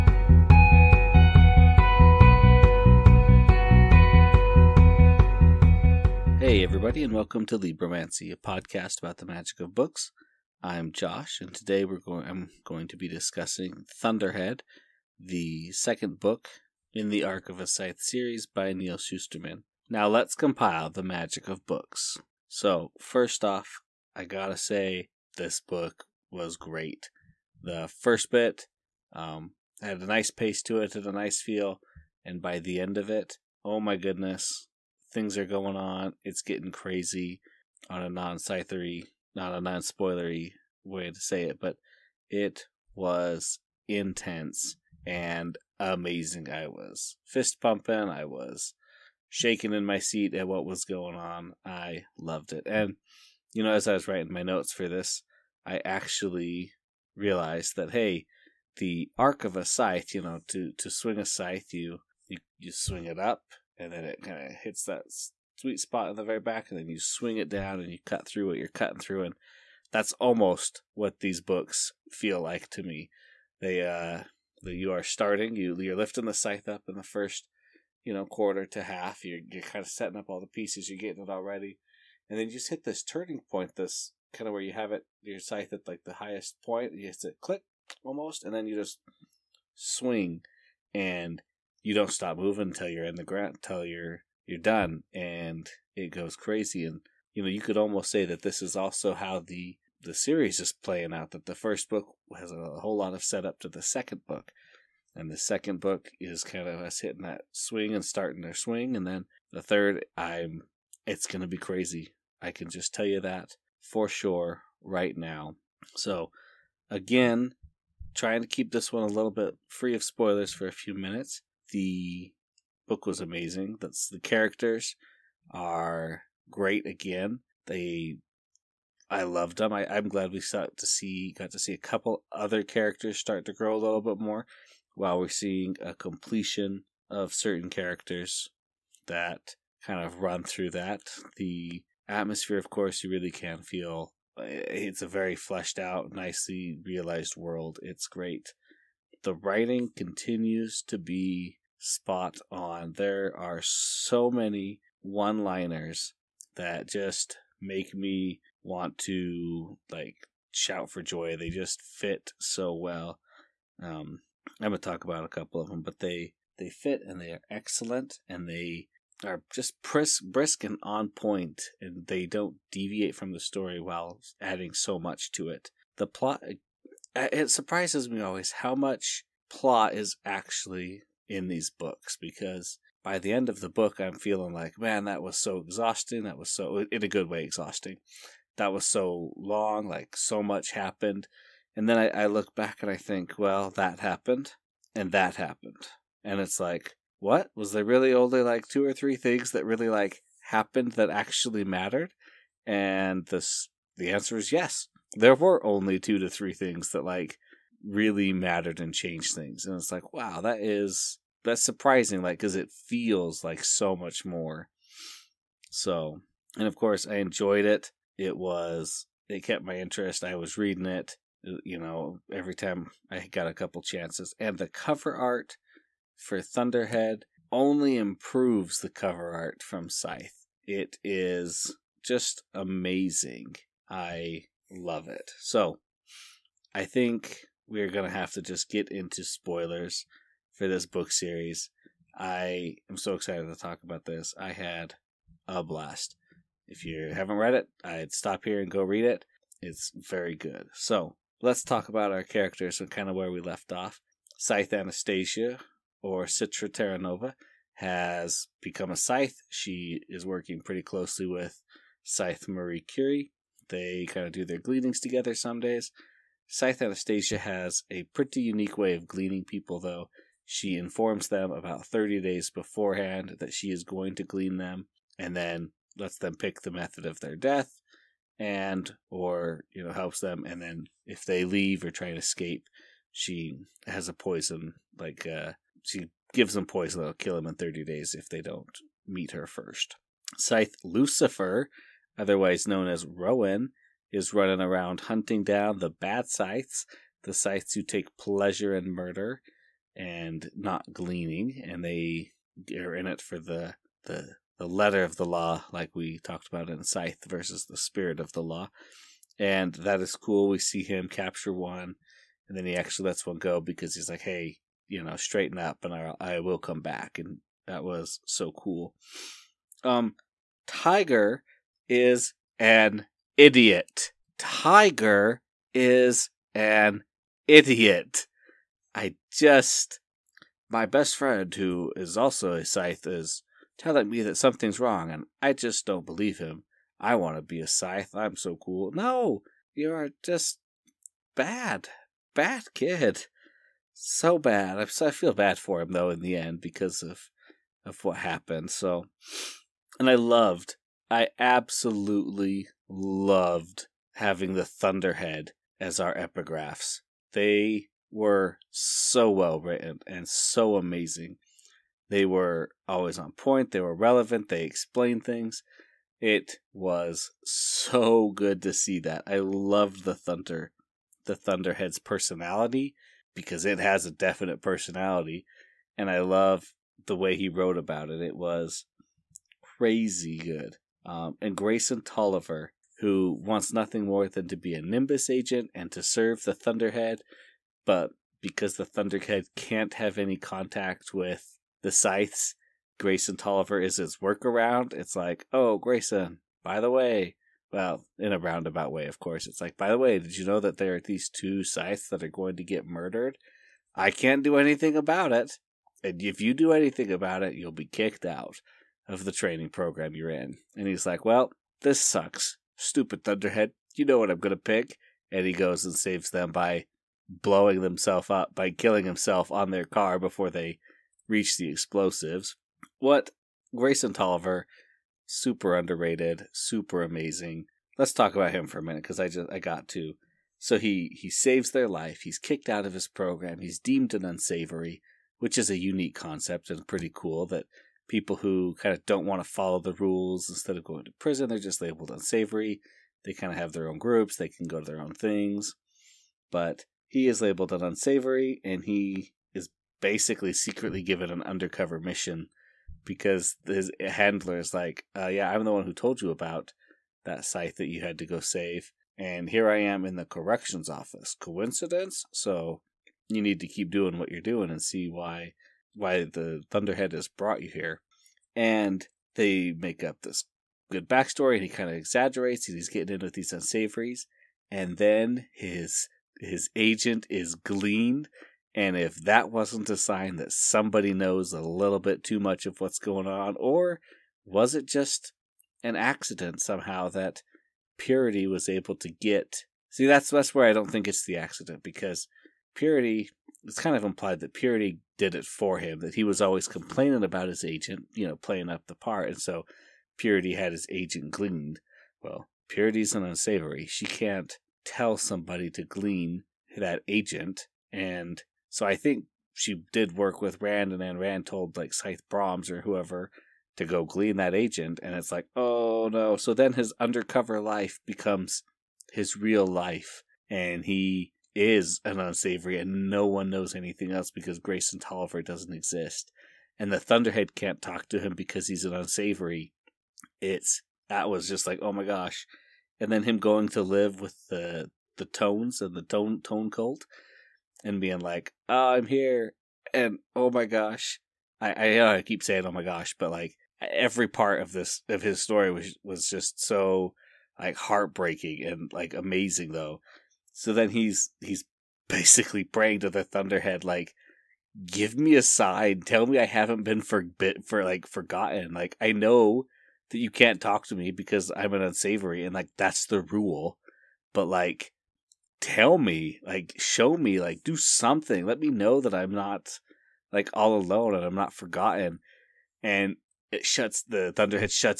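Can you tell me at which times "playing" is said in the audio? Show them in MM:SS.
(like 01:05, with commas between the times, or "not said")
01:40, 08:18.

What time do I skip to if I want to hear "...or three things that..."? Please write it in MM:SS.
03:18.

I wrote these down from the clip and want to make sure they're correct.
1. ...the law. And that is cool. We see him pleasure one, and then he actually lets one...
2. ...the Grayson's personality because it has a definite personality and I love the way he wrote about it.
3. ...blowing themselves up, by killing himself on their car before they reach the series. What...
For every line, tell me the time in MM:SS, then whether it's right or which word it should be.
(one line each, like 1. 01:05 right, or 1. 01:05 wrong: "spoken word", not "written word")
1. 05:08 wrong: "capture", not "pleasure"
2. 06:11 wrong: "Thunderhead", not "Grayson"
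3. 06:57 wrong: "explosives", not "series".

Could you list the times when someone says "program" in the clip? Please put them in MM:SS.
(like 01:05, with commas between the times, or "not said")
06:49, 07:13.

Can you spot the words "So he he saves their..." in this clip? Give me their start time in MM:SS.
07:10.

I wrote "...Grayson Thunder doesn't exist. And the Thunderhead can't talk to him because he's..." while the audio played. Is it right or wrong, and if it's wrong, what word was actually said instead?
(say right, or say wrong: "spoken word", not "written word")
wrong: "Tolliver", not "Thunder".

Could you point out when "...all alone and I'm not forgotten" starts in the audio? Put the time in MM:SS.
09:30.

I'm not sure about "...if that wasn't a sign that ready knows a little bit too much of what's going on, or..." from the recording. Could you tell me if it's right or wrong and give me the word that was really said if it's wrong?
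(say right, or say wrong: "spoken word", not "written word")
wrong: "somebody", not "ready".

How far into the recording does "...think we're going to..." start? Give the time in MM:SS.
03:56.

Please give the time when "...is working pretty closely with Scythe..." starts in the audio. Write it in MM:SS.
04:20.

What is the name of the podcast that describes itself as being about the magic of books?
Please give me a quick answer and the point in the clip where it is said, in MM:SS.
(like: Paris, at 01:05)
Libromancy, at 00:07.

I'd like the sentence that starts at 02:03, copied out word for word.
That's the characters are great again.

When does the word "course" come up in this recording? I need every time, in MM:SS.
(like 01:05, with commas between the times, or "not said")
02:22, 03:36, 06:39.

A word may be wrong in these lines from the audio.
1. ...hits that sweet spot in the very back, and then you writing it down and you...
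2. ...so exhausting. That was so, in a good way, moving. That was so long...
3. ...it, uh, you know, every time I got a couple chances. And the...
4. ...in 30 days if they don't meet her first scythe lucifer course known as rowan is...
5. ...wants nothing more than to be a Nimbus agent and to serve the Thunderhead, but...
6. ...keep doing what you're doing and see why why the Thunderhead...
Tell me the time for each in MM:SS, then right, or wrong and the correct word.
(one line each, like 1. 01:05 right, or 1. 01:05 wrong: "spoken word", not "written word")
1. 01:04 wrong: "swing", not "writing"
2. 03:05 wrong: "exhausting", not "moving"
3. 03:40 right
4. 04:47 wrong: "otherwise", not "course"
5. 06:23 right
6. 07:43 right.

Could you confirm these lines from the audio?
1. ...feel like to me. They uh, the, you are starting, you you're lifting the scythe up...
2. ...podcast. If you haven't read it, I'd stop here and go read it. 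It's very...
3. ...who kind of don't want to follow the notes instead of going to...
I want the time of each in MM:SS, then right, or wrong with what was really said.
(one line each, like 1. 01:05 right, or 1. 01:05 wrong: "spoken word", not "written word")
1. 01:12 right
2. 04:05 wrong: "blast", not "podcast"
3. 07:18 wrong: "rules", not "notes".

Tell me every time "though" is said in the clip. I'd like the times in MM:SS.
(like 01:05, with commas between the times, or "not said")
04:29, 05:45, 09:09.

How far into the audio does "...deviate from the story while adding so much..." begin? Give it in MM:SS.
02:52.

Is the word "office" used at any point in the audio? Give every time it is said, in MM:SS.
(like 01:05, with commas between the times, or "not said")
07:40.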